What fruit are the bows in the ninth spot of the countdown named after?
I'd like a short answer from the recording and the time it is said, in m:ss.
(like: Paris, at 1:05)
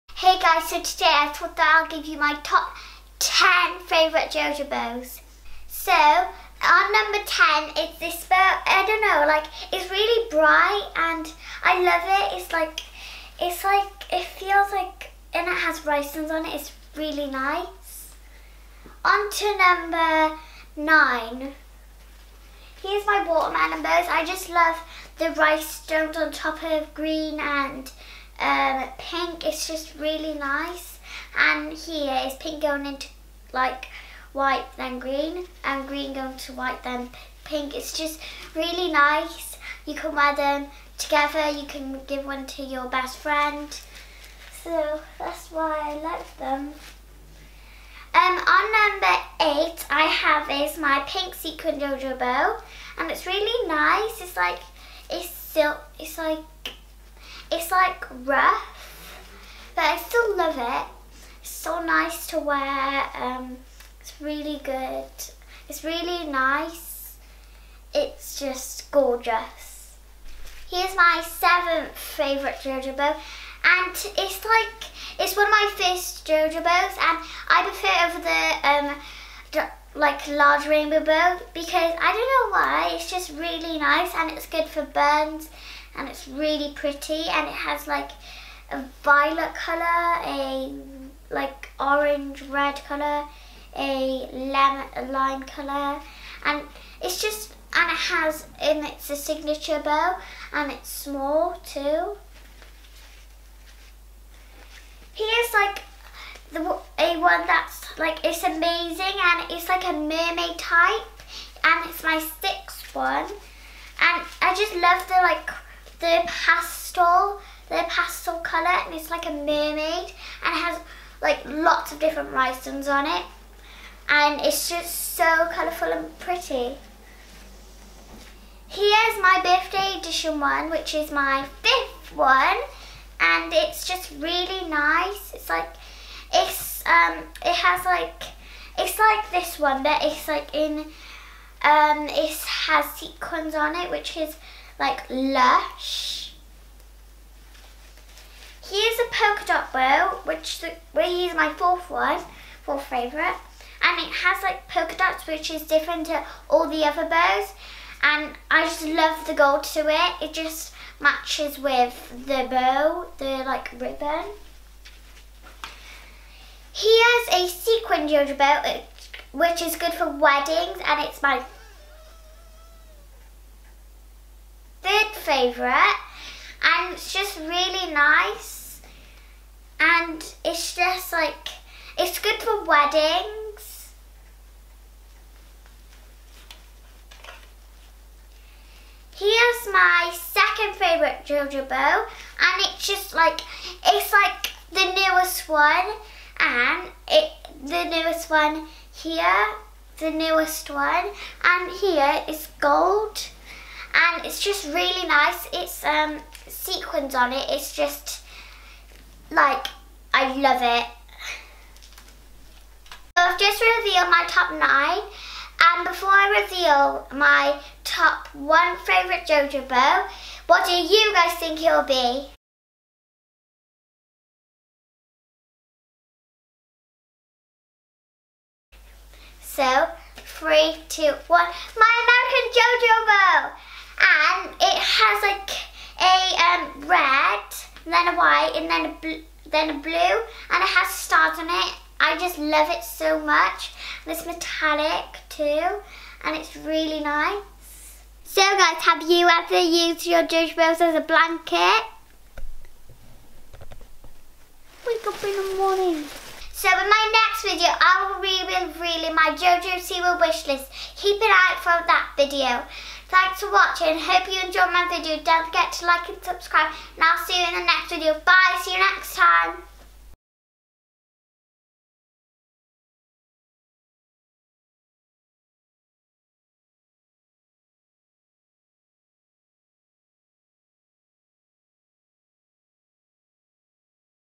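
Watermelon, at 0:23.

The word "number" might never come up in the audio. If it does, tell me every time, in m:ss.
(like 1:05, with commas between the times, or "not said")
0:06, 0:19, 0:48.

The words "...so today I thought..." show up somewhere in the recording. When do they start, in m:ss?
0:00.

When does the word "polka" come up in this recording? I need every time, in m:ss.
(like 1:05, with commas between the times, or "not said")
2:29, 2:34.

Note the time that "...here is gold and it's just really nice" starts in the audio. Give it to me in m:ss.
3:21.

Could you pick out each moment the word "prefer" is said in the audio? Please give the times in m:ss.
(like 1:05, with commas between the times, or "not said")
1:17.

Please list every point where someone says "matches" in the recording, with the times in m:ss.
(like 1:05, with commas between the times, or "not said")
2:40.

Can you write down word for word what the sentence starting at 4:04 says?
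And it's metallic too, and it's really nice.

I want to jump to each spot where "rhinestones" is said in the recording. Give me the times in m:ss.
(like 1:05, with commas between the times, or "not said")
0:15, 0:25, 2:02.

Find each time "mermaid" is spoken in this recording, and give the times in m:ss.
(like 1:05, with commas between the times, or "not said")
1:49, 1:59.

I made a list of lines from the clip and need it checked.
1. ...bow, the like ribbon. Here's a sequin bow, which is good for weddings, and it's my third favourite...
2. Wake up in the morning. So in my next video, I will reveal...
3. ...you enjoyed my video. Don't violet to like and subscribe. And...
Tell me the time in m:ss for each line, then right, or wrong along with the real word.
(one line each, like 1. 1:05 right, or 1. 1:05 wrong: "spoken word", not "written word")
1. 2:42 right
2. 4:14 right
3. 4:24 wrong: "forget", not "violet".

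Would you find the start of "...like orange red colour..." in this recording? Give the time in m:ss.
1:31.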